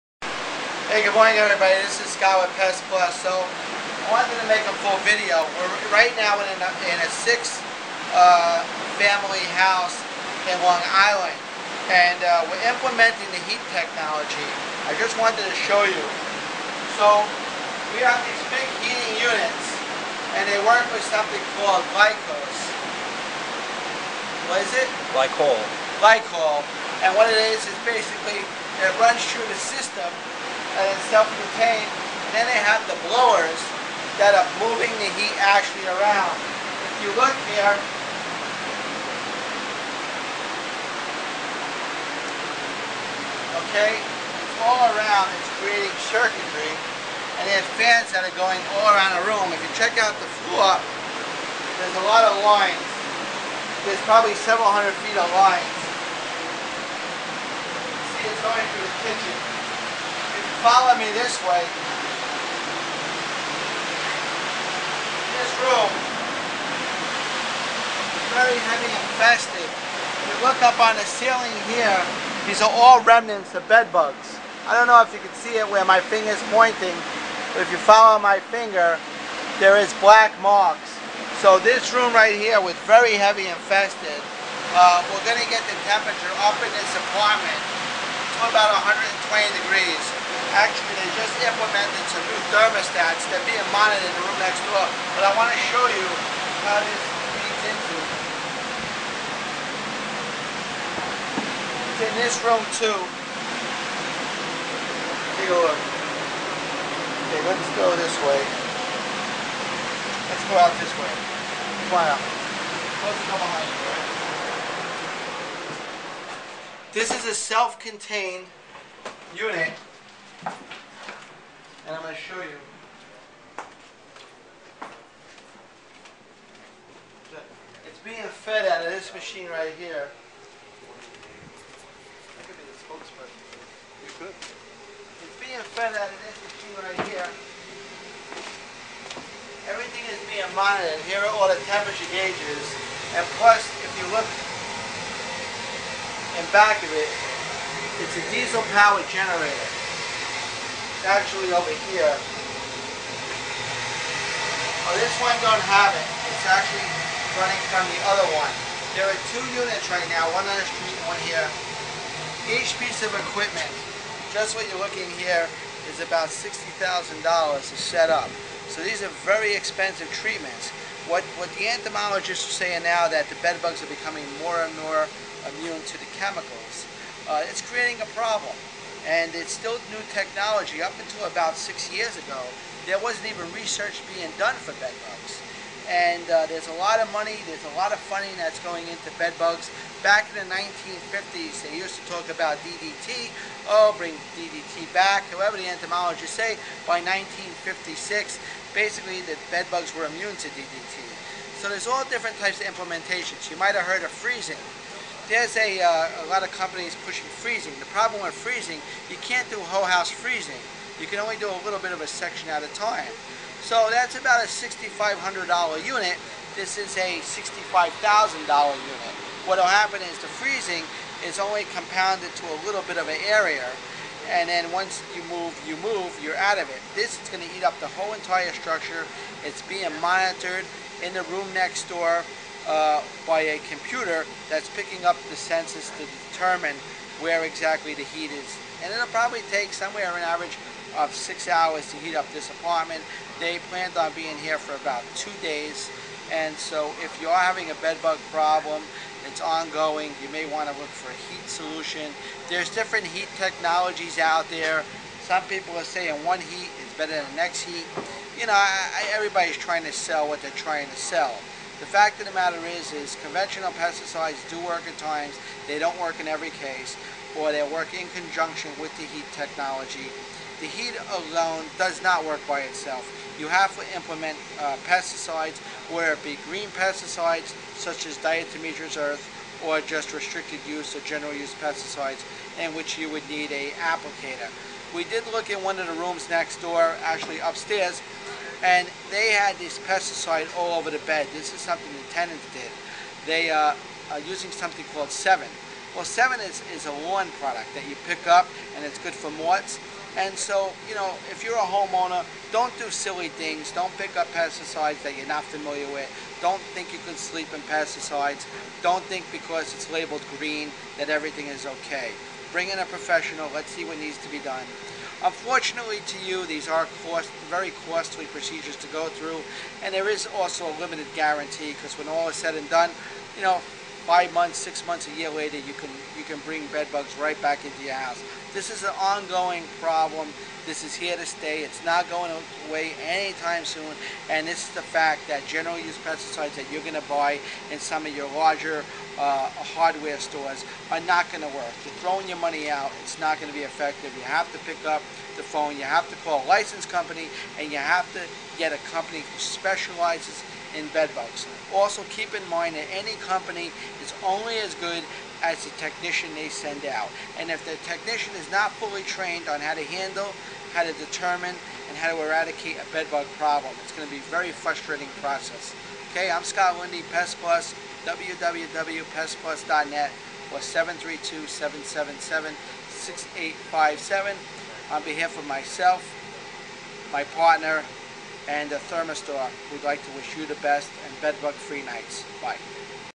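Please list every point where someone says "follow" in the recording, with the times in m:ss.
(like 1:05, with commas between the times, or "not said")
1:00, 1:17.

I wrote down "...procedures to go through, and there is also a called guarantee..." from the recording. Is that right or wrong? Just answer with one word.
wrong.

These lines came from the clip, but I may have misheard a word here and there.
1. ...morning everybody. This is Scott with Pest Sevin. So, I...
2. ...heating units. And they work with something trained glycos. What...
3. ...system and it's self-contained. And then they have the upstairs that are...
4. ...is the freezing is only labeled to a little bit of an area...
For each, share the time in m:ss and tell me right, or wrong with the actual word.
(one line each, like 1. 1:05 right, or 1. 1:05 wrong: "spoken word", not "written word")
1. 0:01 wrong: "Plus", not "Sevin"
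2. 0:18 wrong: "called", not "trained"
3. 0:29 wrong: "blowers", not "upstairs"
4. 3:40 wrong: "compounded", not "labeled".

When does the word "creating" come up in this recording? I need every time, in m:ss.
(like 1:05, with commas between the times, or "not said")
0:45, 2:57.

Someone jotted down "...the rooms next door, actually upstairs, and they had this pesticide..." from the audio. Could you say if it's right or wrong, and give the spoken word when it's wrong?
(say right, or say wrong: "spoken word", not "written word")
right.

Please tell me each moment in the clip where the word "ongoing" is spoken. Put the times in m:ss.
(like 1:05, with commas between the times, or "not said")
4:09, 5:28.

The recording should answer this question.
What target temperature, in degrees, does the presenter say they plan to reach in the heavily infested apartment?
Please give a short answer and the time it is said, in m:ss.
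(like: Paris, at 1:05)
120, at 1:28.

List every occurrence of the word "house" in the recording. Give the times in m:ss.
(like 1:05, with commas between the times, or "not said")
0:09, 3:29, 5:27.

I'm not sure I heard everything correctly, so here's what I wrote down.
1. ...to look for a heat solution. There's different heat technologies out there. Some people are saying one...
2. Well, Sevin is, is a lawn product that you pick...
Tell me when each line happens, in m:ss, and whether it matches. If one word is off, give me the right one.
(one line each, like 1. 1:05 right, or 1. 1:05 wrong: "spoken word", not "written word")
1. 4:10 right
2. 4:55 right.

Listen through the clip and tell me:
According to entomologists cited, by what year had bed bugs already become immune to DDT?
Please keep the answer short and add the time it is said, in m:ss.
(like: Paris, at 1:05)
1956, at 3:16.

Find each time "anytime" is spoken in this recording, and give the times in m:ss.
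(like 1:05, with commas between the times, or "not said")
5:33.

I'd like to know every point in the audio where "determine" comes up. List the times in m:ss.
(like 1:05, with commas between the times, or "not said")
3:56, 6:00.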